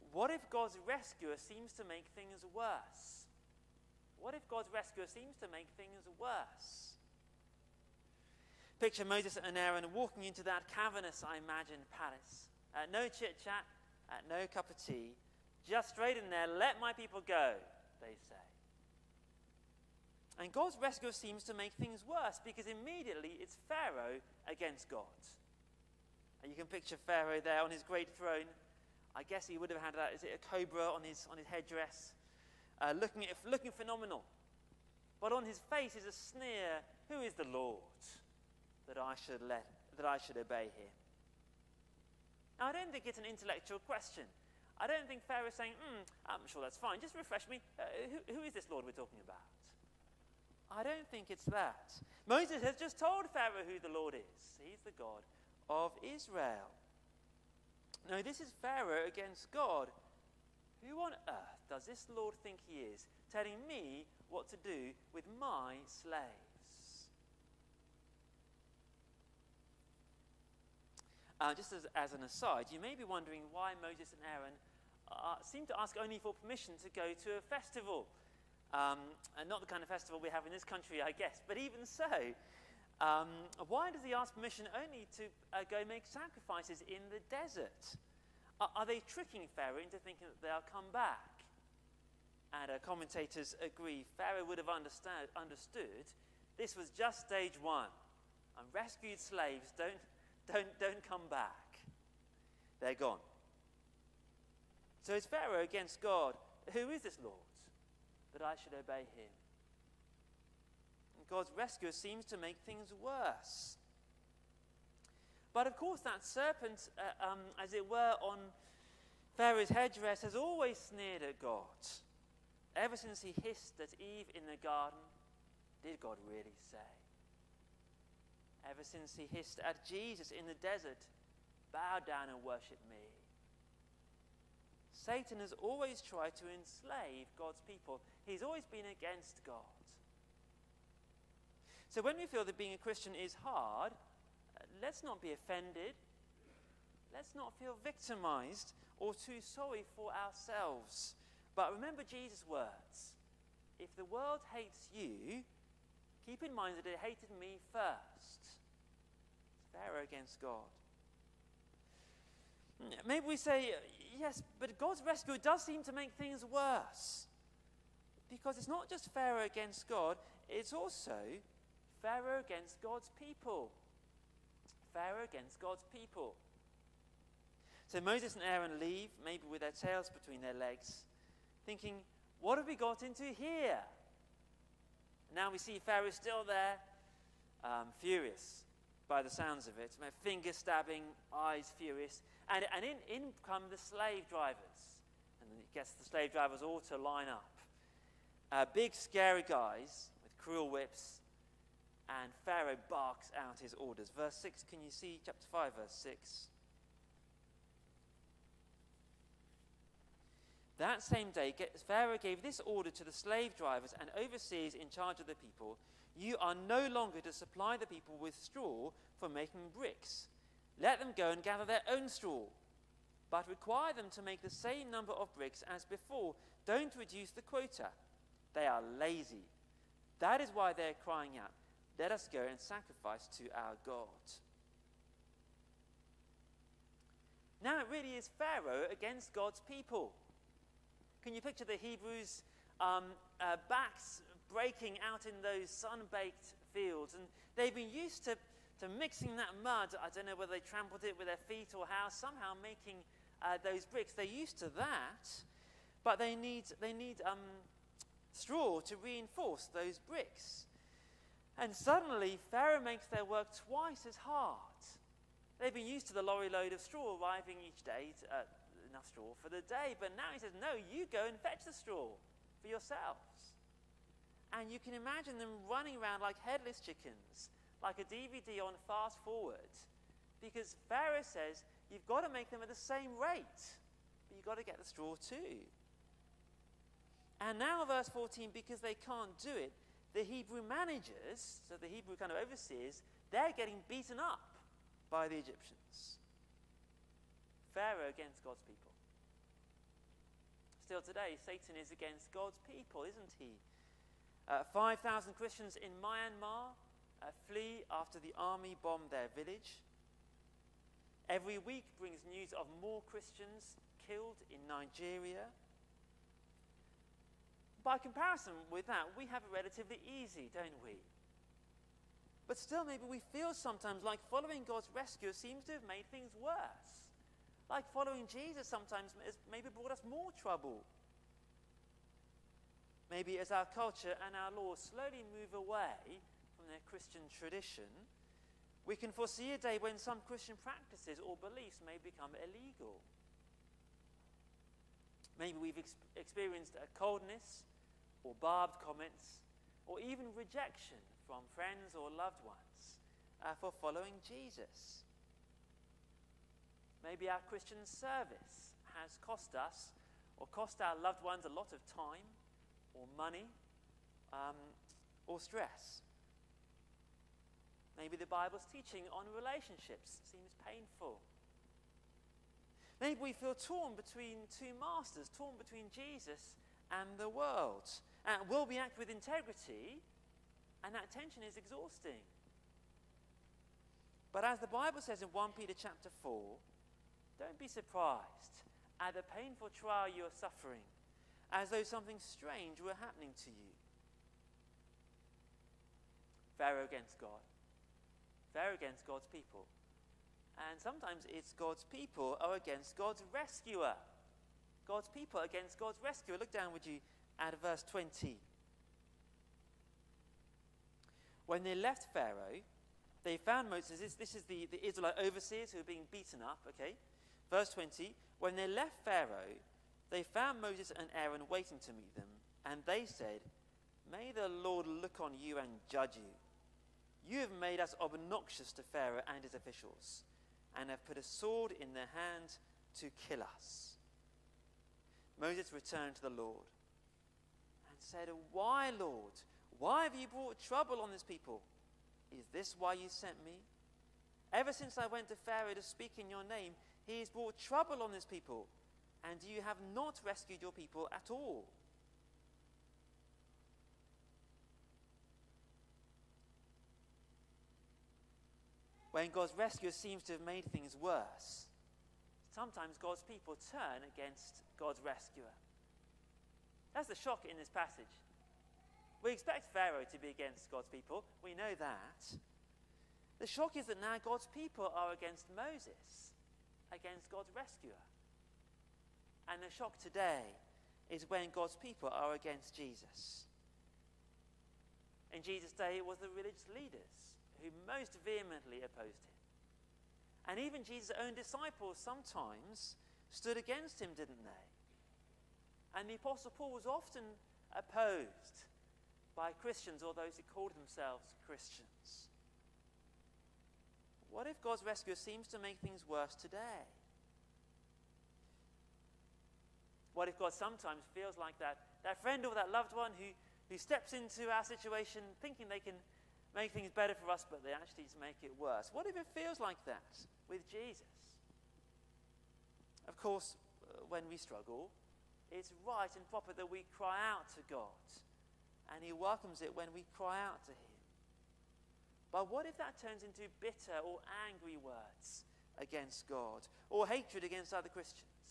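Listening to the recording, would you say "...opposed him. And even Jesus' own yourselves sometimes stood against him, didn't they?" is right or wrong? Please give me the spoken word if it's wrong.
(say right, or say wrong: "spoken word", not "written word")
wrong: "disciples", not "yourselves".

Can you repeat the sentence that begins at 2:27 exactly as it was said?
Let's not feel victimized or too sorry for ourselves.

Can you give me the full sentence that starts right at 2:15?
Satan has always tried to enslave God's people, he's always been against God.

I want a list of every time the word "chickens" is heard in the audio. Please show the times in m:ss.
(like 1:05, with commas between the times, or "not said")
4:36.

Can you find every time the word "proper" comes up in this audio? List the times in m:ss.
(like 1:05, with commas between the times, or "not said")
8:46.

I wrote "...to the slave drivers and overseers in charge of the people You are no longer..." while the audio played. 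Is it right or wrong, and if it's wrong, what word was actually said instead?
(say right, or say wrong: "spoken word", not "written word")
right.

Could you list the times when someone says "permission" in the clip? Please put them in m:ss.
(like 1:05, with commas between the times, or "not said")
1:16, 1:24.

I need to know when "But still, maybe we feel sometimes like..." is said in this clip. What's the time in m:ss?
5:22.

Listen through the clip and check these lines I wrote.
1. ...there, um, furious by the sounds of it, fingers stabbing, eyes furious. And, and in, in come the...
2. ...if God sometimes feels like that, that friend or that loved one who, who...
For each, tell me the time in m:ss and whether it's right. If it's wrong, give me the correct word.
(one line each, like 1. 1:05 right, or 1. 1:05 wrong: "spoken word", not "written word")
1. 3:06 right
2. 8:30 right.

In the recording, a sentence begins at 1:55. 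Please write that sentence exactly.
But of course, that serpent, uh, um, as it were, on Pharaoh's headdress has always sneered at God.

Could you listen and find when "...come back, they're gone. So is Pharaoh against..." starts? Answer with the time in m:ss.
1:41.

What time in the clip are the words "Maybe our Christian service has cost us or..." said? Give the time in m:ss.
5:57.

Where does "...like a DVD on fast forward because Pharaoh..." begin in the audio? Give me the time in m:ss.
4:37.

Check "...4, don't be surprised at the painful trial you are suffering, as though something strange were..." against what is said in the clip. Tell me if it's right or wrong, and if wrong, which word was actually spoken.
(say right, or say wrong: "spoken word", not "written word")
right.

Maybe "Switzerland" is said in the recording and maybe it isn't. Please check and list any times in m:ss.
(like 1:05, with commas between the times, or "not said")
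not said.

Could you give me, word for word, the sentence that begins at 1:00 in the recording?
Who on earth does this Lord think he is, telling me what to do with my slaves?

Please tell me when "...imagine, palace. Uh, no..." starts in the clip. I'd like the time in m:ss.
0:11.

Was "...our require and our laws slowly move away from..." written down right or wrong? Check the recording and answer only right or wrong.
wrong.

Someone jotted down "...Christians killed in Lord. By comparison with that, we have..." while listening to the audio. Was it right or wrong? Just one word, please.
wrong.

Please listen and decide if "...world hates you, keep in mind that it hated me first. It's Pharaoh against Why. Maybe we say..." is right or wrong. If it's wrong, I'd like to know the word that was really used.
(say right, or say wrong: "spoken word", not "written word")
wrong: "God", not "Why".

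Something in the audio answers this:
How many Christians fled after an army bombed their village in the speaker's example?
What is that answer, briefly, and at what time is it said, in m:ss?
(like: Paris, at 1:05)
5,000, at 5:04.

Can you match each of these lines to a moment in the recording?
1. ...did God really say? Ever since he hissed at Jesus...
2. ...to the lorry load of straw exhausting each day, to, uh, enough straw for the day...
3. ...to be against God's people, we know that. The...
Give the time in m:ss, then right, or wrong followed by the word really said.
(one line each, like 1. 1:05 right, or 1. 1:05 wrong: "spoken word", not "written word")
1. 2:05 right
2. 4:26 wrong: "arriving", not "exhausting"
3. 7:50 right.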